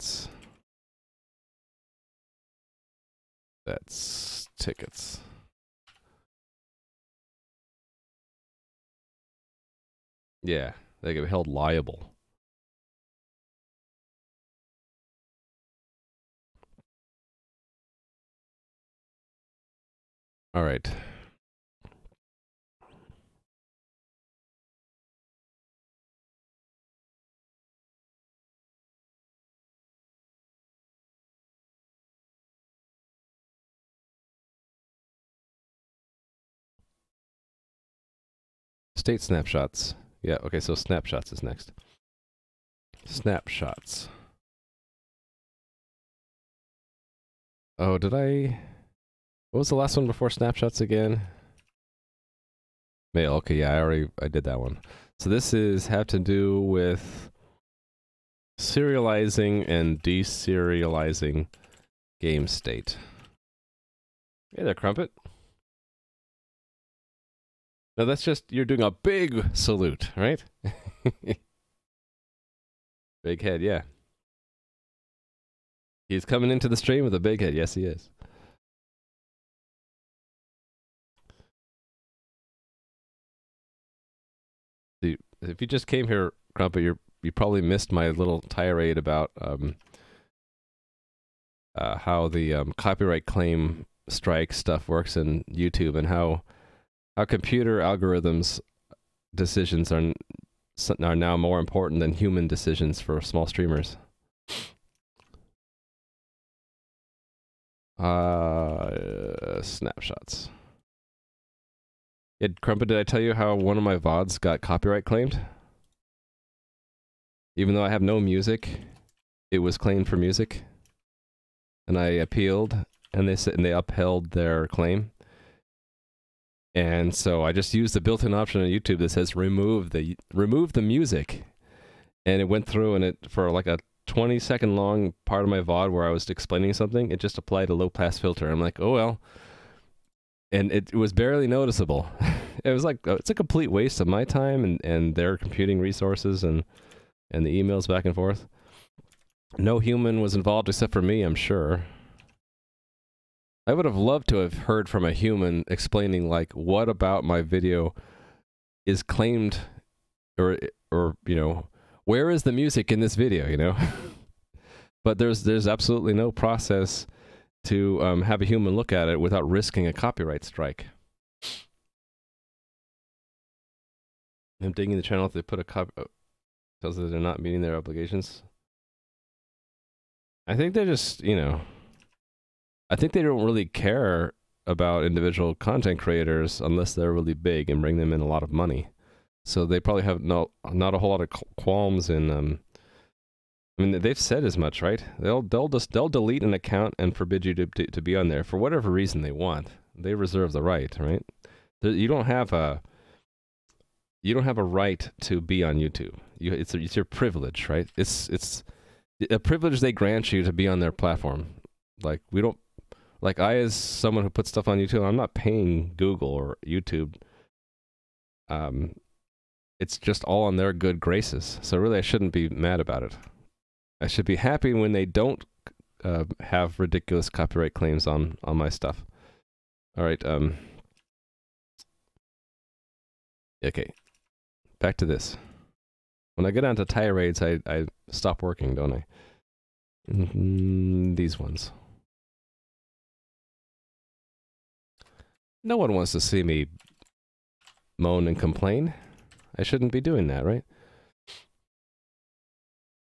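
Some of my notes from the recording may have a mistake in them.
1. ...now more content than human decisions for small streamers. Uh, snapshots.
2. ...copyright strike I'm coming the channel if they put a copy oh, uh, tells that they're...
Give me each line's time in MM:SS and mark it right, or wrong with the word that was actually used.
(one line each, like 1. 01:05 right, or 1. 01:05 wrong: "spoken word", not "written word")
1. 01:41 wrong: "important", not "content"
2. 02:49 wrong: "digging", not "coming".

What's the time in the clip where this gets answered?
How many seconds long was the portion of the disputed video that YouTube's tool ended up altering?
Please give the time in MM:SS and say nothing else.
02:14.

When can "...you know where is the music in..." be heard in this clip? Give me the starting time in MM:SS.
02:41.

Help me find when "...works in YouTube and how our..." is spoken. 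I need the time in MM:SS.
01:34.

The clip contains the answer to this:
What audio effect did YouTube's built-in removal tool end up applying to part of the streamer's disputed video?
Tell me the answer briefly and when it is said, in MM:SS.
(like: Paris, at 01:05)
low pass filter, at 02:17.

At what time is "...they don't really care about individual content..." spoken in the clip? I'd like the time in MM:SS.
03:03.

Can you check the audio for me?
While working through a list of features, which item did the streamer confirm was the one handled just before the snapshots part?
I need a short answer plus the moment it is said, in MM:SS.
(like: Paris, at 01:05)
Mail, at 00:53.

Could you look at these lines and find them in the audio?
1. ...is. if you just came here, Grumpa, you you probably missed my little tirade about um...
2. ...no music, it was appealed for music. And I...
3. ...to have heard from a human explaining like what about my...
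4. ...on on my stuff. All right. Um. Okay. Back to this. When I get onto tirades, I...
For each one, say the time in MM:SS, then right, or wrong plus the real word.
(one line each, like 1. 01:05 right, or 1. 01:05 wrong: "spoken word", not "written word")
1. 01:17 right
2. 01:58 wrong: "claimed", not "appealed"
3. 02:34 right
4. 03:48 right.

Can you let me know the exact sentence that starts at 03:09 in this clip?
So they probably have no not a whole lot of qualms in.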